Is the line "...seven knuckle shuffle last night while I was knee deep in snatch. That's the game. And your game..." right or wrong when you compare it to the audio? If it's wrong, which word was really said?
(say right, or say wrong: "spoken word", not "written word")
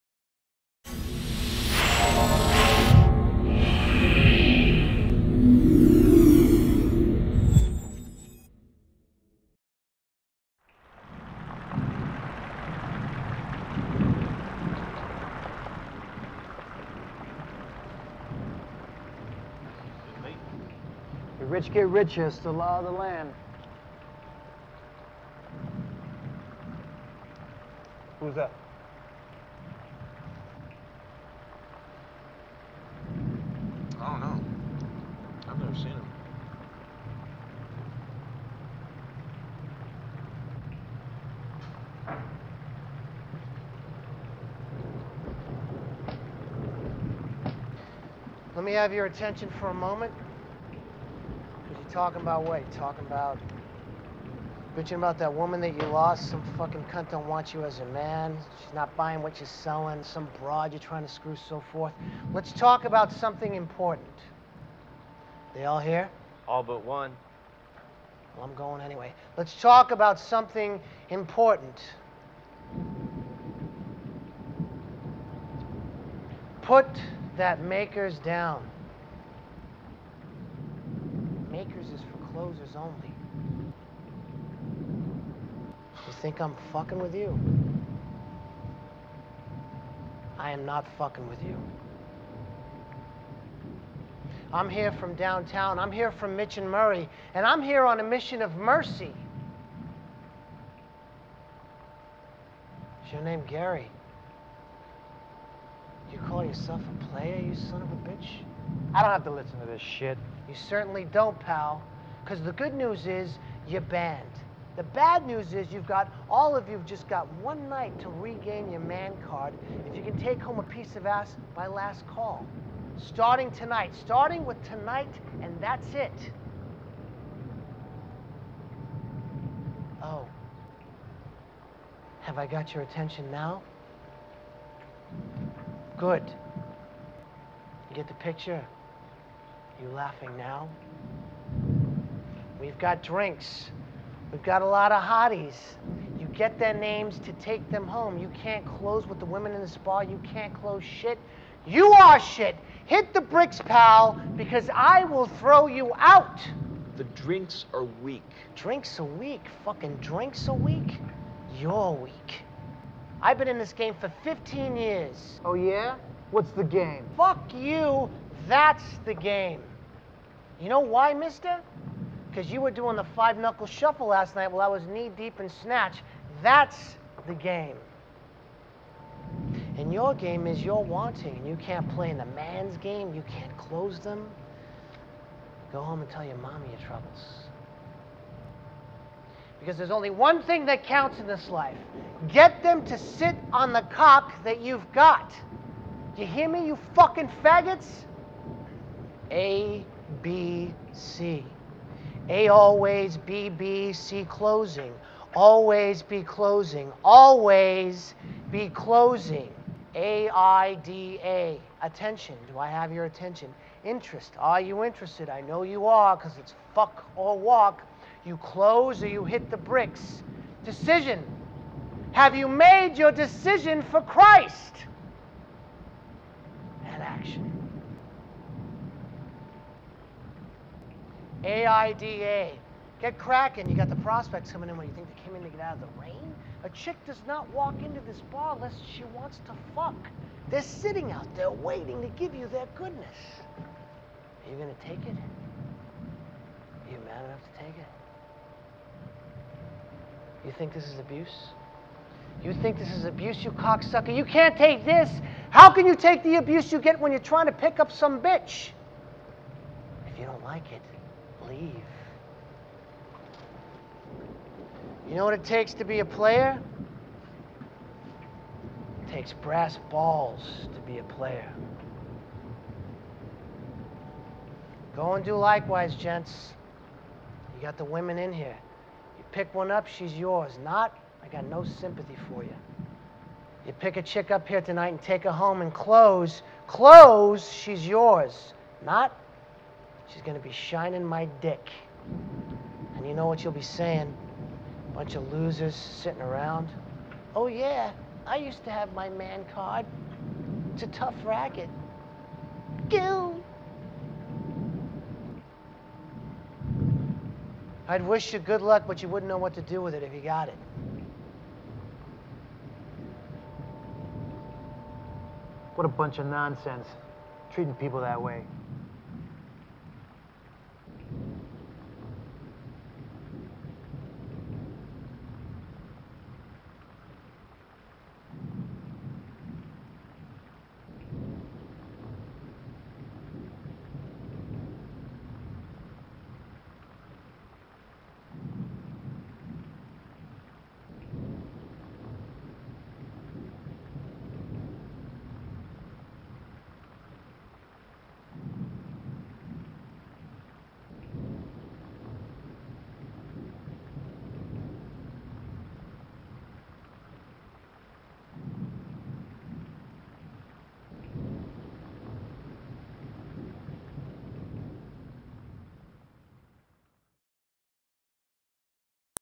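wrong: "five", not "seven".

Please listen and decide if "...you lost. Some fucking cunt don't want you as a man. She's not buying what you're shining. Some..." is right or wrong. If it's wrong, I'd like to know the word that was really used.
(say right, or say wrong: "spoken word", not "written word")
wrong: "selling", not "shining".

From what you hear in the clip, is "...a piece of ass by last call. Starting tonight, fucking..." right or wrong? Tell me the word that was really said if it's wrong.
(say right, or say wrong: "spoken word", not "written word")
wrong: "starting", not "fucking".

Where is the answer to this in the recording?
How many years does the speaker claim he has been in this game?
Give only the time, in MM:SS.
02:44.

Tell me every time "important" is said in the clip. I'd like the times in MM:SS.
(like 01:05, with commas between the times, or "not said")
01:03, 01:11.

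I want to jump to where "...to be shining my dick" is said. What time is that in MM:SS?
04:50.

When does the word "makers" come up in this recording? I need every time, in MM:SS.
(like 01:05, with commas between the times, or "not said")
01:17, 01:21.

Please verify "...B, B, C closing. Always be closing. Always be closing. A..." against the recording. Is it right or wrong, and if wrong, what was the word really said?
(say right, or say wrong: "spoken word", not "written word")
right.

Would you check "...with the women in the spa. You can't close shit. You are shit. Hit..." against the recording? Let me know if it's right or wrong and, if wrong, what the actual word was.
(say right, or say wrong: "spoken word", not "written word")
right.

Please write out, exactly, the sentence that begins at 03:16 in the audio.
Do you hear me, you fucking faggots?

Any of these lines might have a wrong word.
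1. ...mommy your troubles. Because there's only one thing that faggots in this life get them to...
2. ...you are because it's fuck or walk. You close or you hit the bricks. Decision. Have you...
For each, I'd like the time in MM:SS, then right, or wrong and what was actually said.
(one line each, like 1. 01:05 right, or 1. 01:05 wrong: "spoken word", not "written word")
1. 03:06 wrong: "counts", not "faggots"
2. 03:35 right.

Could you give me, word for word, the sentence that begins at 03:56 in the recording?
A chick does not walk into this bar unless she wants to fuck.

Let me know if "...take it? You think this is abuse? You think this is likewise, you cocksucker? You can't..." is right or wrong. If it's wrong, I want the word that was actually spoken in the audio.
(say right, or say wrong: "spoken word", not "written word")
wrong: "abuse", not "likewise".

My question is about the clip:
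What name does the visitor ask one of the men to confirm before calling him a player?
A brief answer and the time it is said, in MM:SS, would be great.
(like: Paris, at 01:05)
Gary, at 01:43.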